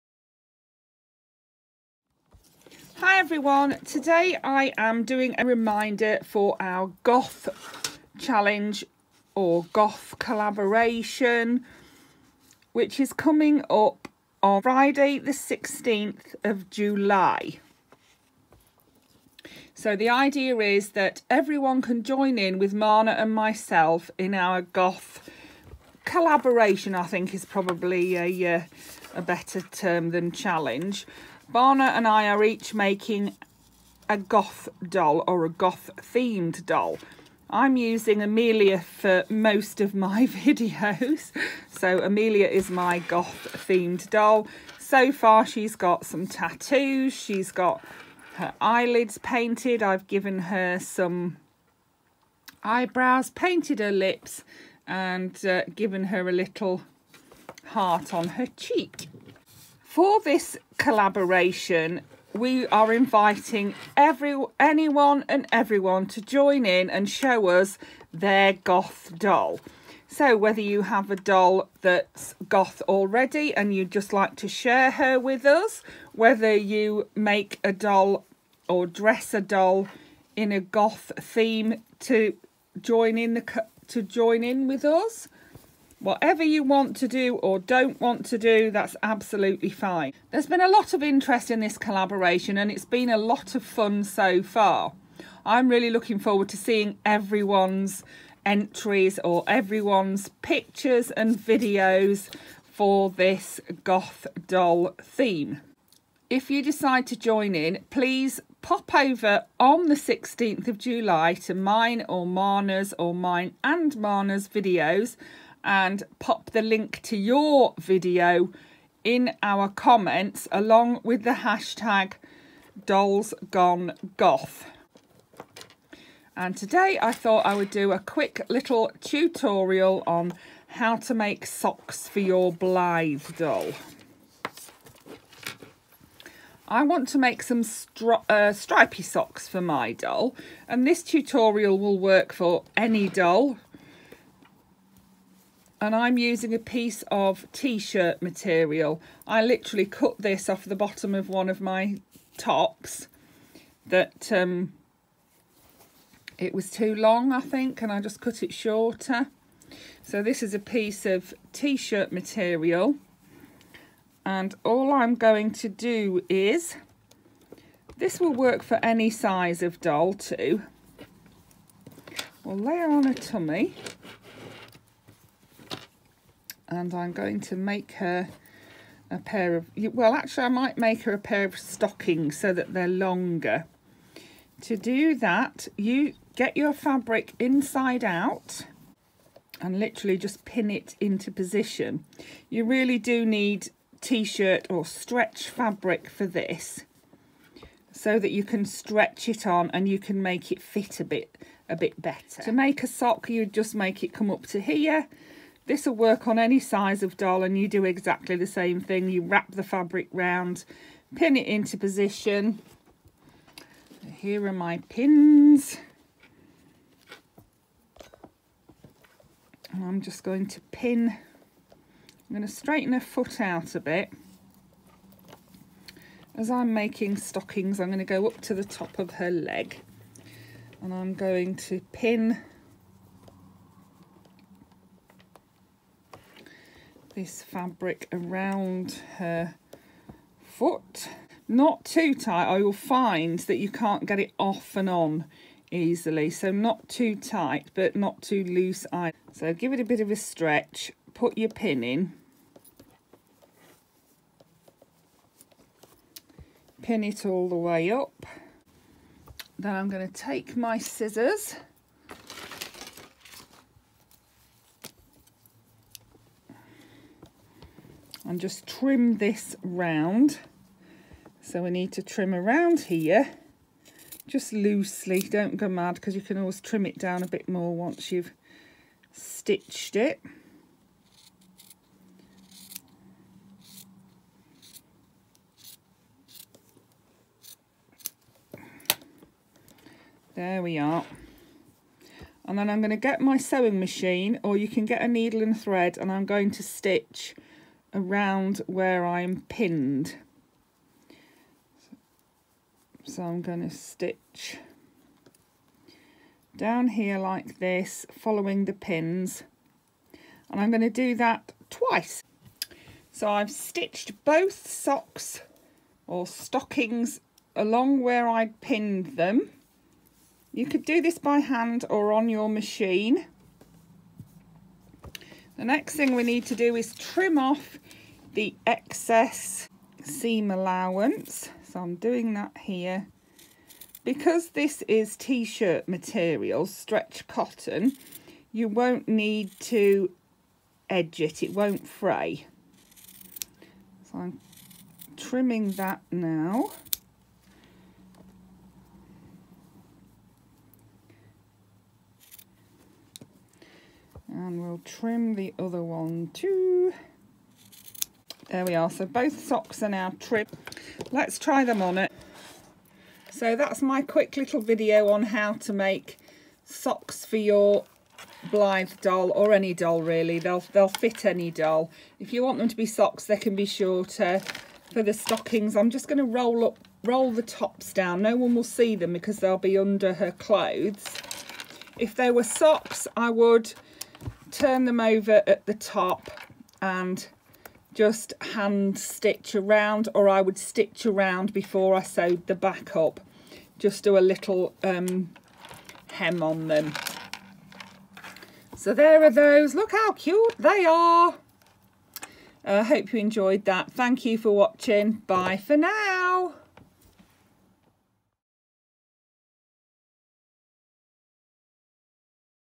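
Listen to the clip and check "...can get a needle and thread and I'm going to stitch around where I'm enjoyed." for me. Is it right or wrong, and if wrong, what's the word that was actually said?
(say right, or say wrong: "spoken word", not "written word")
wrong: "pinned", not "enjoyed".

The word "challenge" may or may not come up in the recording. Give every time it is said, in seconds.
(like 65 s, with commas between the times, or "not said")
8 s, 30 s.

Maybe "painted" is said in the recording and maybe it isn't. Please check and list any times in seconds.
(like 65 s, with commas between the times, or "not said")
49 s, 53 s.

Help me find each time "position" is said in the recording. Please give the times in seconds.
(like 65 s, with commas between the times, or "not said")
191 s, 211 s.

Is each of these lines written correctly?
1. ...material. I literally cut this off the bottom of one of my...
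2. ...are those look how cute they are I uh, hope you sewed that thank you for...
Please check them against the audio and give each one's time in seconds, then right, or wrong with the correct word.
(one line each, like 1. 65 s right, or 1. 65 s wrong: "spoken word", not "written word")
1. 148 s right
2. 399 s wrong: "enjoyed", not "sewed".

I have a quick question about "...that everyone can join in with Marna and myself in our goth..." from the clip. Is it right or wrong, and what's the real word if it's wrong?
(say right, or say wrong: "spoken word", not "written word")
right.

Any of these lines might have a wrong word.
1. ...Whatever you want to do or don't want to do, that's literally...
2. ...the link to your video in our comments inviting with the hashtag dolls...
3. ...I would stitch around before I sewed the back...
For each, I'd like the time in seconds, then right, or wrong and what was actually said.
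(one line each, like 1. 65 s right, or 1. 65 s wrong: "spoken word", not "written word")
1. 86 s wrong: "absolutely", not "literally"
2. 116 s wrong: "along", not "inviting"
3. 390 s right.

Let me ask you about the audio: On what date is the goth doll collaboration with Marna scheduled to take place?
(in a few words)
Friday 16th of July.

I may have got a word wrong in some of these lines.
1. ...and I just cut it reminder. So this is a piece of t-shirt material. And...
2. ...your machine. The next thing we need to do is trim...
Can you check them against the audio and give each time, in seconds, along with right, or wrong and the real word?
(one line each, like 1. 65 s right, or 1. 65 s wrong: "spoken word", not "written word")
1. 157 s wrong: "shorter", not "reminder"
2. 322 s right.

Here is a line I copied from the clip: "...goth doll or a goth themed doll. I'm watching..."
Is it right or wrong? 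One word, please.
wrong.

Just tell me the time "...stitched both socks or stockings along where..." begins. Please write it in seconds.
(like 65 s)
313 s.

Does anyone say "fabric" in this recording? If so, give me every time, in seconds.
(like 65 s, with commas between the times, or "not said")
186 s, 195 s, 209 s, 237 s.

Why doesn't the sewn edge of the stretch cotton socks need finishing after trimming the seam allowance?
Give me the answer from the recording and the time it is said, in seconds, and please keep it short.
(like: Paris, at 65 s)
It won't fray, at 341 s.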